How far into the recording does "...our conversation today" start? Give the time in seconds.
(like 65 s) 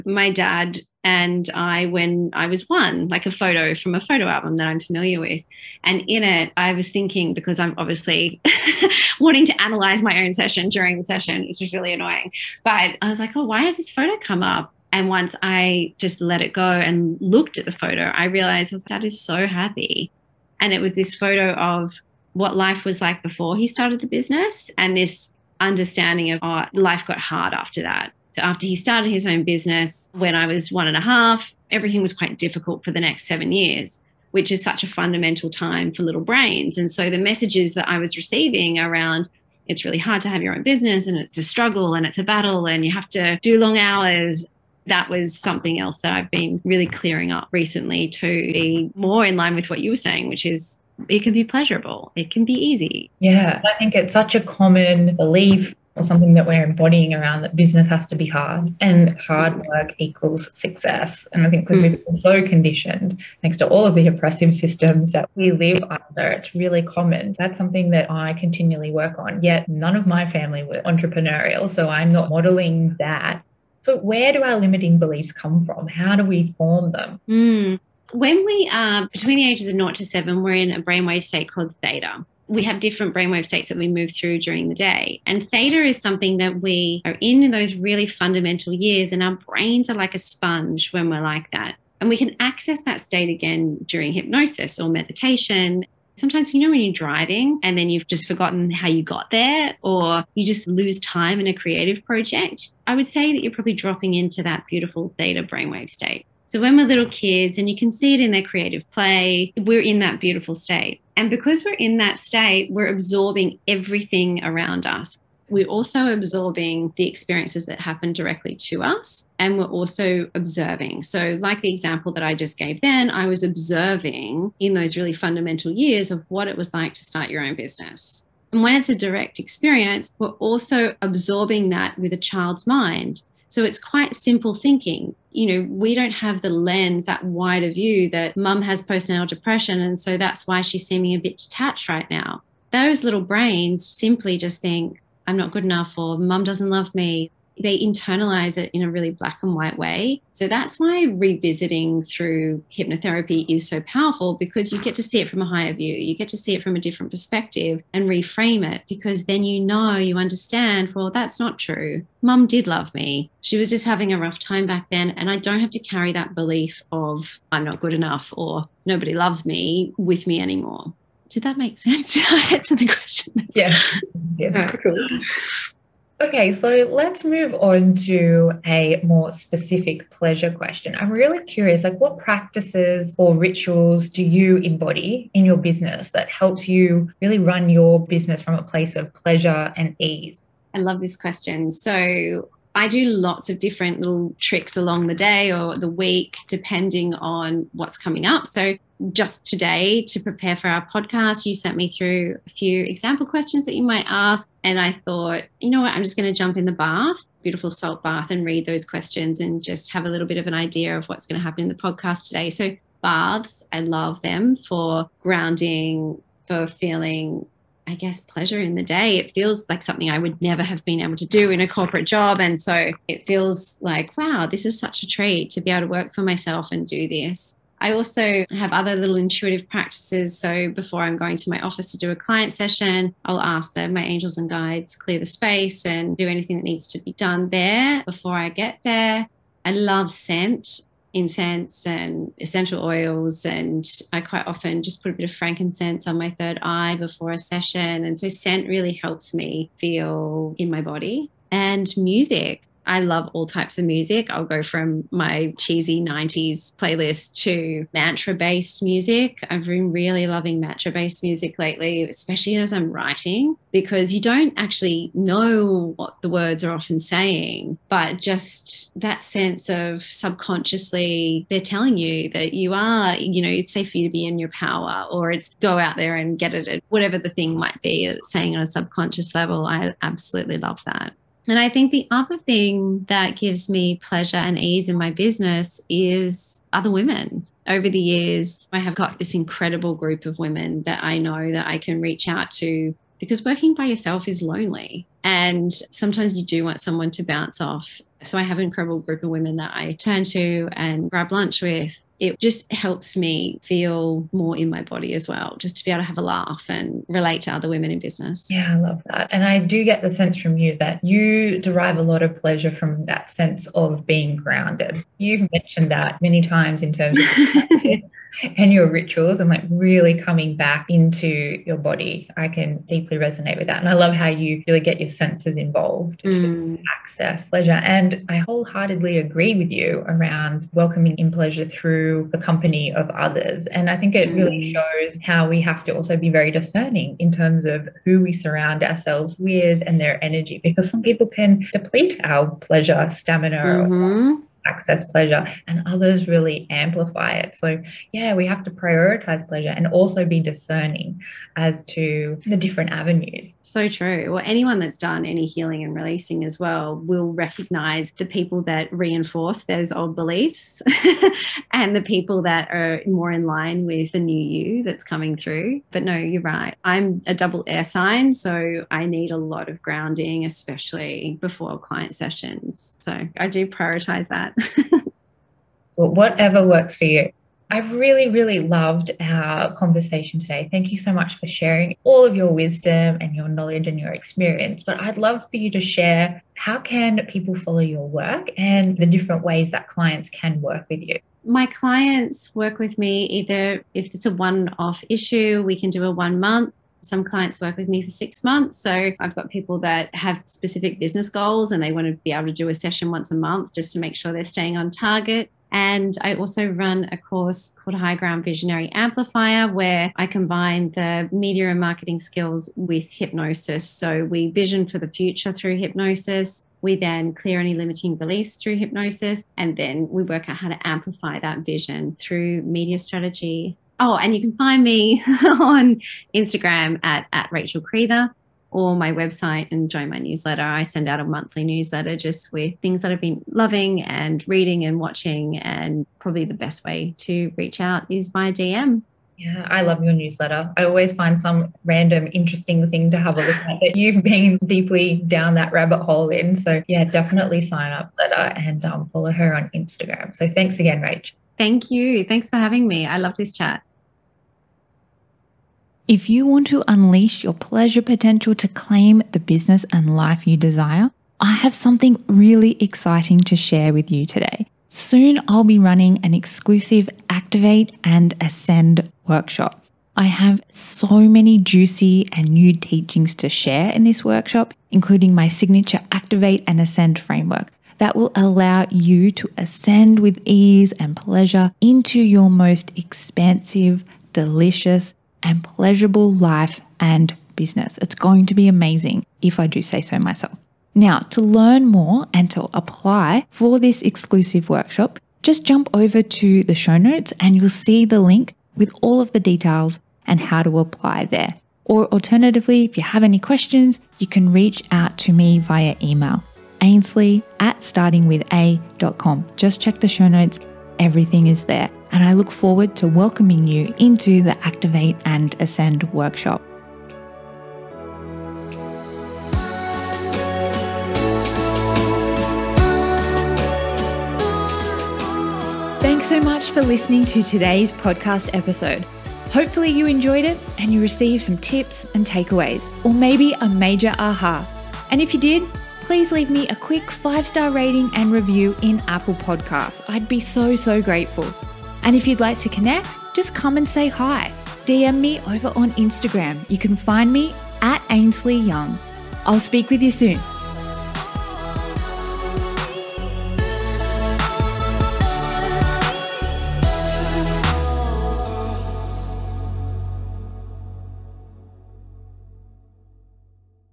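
379 s.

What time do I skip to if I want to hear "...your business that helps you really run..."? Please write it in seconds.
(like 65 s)
185 s.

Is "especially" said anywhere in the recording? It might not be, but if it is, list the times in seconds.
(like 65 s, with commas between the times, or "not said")
262 s, 370 s.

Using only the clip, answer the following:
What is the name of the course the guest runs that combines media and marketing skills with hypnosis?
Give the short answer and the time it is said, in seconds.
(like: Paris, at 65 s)
High Ground Visionary Amplifier, at 407 s.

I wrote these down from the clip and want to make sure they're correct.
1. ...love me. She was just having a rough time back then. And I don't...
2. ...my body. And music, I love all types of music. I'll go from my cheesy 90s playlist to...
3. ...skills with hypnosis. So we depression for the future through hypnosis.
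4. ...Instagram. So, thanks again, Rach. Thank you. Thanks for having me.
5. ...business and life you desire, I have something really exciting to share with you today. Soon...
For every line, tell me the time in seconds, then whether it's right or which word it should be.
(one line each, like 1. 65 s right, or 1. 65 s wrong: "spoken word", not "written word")
1. 162 s right
2. 250 s right
3. 412 s wrong: "vision", not "depression"
4. 449 s right
5. 459 s right.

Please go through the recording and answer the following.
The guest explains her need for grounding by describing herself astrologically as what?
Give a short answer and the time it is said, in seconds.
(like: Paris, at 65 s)
double air sign, at 367 s.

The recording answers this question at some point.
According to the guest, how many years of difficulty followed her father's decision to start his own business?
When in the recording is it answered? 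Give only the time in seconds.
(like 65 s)
33 s.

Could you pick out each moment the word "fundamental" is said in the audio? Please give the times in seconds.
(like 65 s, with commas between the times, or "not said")
34 s, 88 s, 125 s.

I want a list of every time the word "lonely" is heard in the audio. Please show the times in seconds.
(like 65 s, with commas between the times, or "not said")
294 s.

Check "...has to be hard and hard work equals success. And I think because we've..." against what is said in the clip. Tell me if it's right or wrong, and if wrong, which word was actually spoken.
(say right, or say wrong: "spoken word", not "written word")
right.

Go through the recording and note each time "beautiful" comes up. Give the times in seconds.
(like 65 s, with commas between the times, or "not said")
104 s, 110 s, 207 s.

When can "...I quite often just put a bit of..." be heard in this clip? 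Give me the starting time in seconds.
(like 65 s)
244 s.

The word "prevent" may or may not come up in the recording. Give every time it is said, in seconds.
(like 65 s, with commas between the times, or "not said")
not said.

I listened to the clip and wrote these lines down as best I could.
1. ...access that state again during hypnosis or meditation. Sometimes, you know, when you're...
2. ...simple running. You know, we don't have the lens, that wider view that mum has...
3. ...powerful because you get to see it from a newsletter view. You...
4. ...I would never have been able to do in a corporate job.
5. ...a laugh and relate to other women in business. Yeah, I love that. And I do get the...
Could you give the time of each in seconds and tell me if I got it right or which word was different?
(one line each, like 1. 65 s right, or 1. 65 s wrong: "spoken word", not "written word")
1. 92 s right
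2. 134 s wrong: "thinking", not "running"
3. 153 s wrong: "higher", not "newsletter"
4. 220 s right
5. 306 s right.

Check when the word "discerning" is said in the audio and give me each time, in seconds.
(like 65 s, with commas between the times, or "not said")
336 s, 350 s.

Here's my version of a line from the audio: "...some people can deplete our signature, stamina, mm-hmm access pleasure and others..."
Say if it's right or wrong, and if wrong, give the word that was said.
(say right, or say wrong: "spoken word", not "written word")
wrong: "pleasure", not "signature".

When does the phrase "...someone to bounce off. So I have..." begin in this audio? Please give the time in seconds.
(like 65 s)
296 s.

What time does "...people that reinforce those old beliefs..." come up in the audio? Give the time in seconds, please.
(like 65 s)
358 s.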